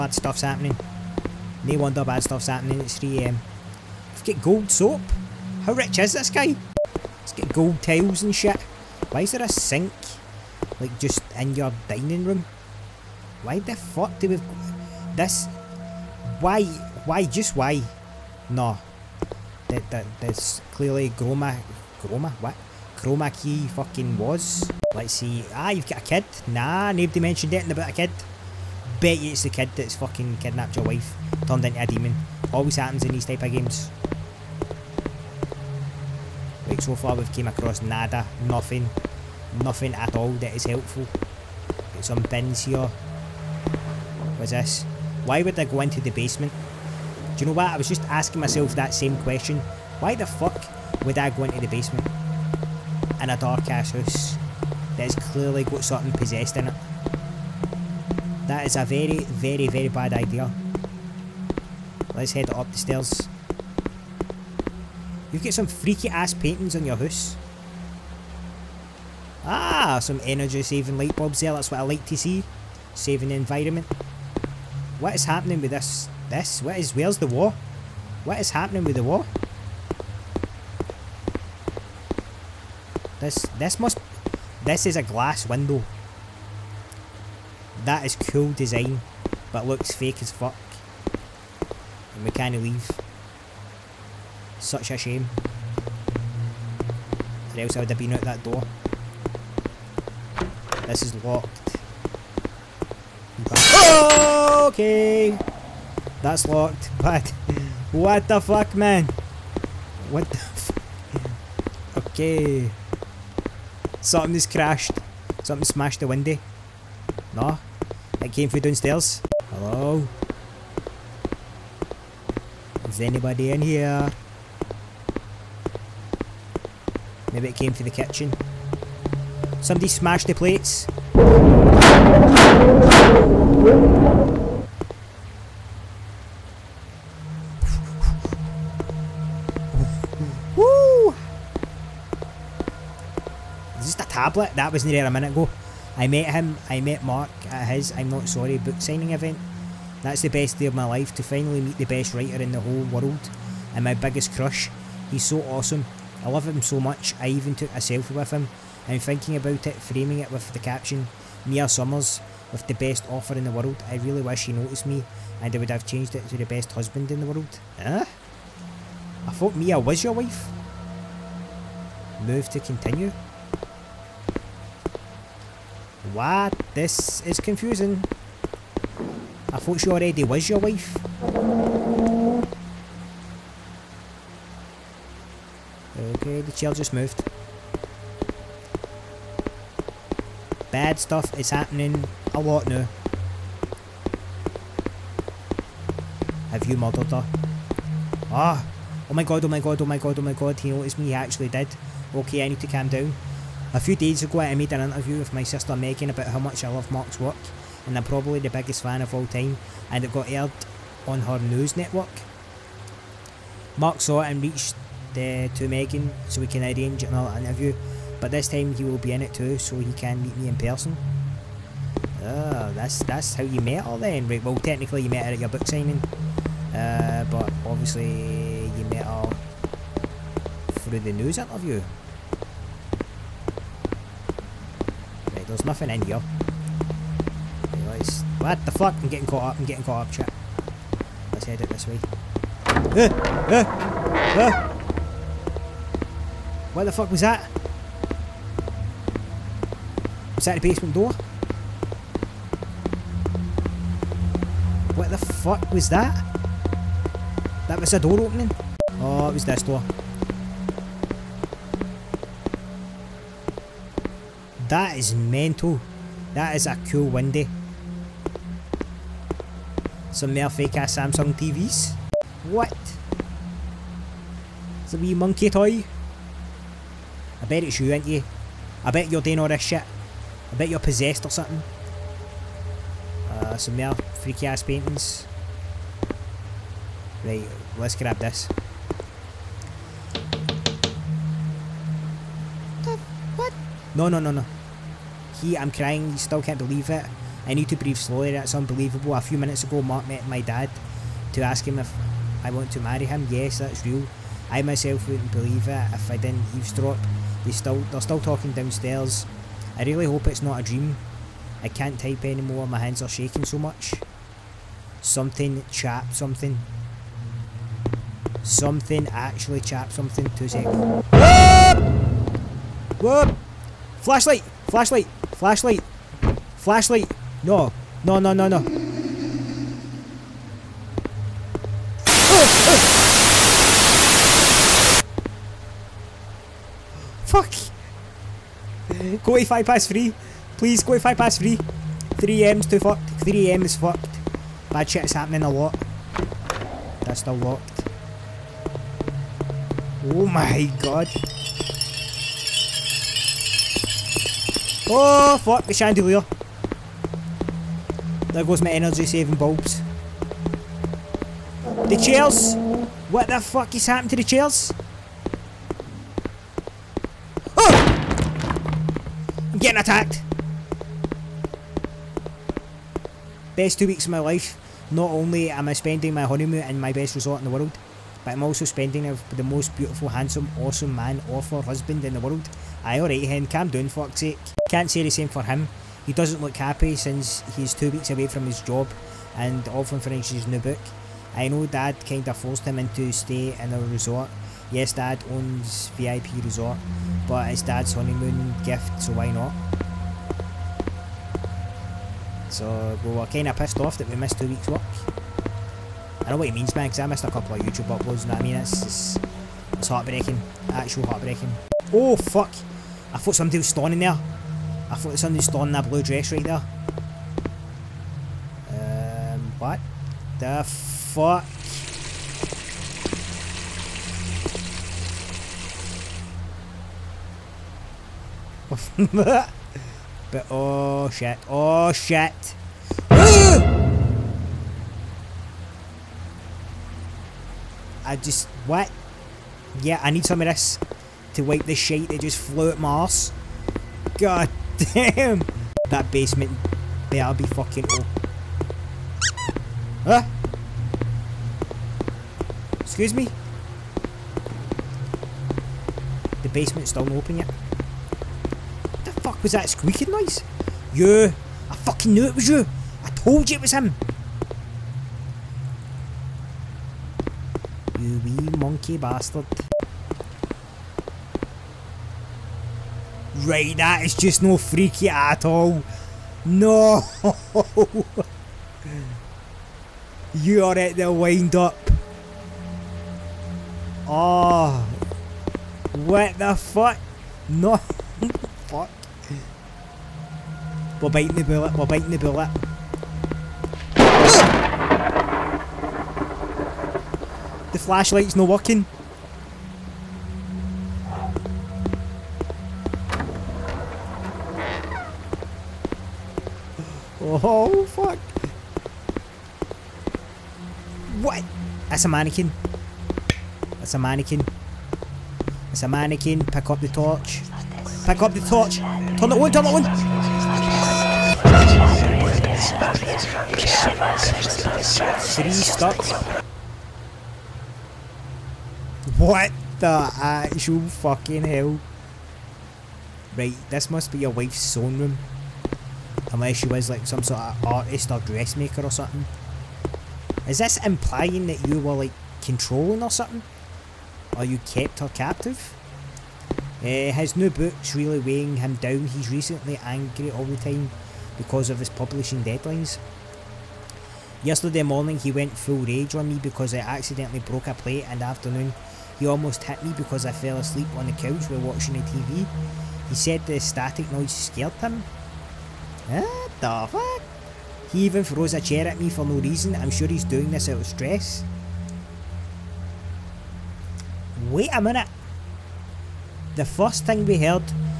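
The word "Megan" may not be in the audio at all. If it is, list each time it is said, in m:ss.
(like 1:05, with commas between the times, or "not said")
3:25, 3:35.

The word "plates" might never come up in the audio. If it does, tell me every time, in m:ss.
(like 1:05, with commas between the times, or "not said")
2:10, 9:17.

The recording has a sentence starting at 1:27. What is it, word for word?
That is cool design, but looks fake as fuck.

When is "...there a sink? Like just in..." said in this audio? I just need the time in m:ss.
0:09.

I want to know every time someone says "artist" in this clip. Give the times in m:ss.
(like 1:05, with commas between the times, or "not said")
8:57.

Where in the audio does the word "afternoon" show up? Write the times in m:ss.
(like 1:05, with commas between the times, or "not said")
9:18.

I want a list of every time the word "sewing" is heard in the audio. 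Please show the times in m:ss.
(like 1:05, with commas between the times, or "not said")
8:54.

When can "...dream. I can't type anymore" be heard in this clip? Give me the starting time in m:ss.
5:10.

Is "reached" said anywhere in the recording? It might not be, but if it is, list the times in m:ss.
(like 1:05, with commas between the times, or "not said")
3:34.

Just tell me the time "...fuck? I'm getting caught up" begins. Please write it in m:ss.
3:58.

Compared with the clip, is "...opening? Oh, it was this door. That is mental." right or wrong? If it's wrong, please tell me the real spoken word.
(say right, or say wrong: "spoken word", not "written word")
right.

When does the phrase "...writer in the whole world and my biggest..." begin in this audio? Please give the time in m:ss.
2:32.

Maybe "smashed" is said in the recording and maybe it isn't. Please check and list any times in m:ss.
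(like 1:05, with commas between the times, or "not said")
1:55, 2:09.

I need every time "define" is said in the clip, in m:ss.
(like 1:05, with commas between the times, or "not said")
not said.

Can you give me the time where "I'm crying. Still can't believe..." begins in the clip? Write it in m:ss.
4:55.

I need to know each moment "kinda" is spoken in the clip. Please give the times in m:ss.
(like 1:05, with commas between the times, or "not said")
6:32, 6:43.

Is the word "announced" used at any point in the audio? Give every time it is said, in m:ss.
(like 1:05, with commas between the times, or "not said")
not said.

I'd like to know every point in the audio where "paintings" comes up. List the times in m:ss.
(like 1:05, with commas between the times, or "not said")
1:06, 4:44.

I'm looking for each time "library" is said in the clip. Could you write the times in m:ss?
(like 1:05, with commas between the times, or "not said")
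not said.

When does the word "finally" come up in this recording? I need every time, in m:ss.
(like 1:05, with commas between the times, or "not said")
2:31.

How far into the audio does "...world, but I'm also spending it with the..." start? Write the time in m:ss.
6:17.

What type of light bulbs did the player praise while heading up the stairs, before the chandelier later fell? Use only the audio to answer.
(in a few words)
energy saving bulbs.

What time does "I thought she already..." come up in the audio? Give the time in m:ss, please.
2:59.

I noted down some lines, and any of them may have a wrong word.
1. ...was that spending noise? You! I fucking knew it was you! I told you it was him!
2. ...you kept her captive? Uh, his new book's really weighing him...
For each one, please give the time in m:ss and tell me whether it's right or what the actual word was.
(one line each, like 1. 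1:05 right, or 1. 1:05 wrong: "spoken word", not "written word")
1. 7:39 wrong: "squeaking", not "spending"
2. 9:04 right.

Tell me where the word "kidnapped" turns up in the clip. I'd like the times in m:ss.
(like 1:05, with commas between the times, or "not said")
0:30.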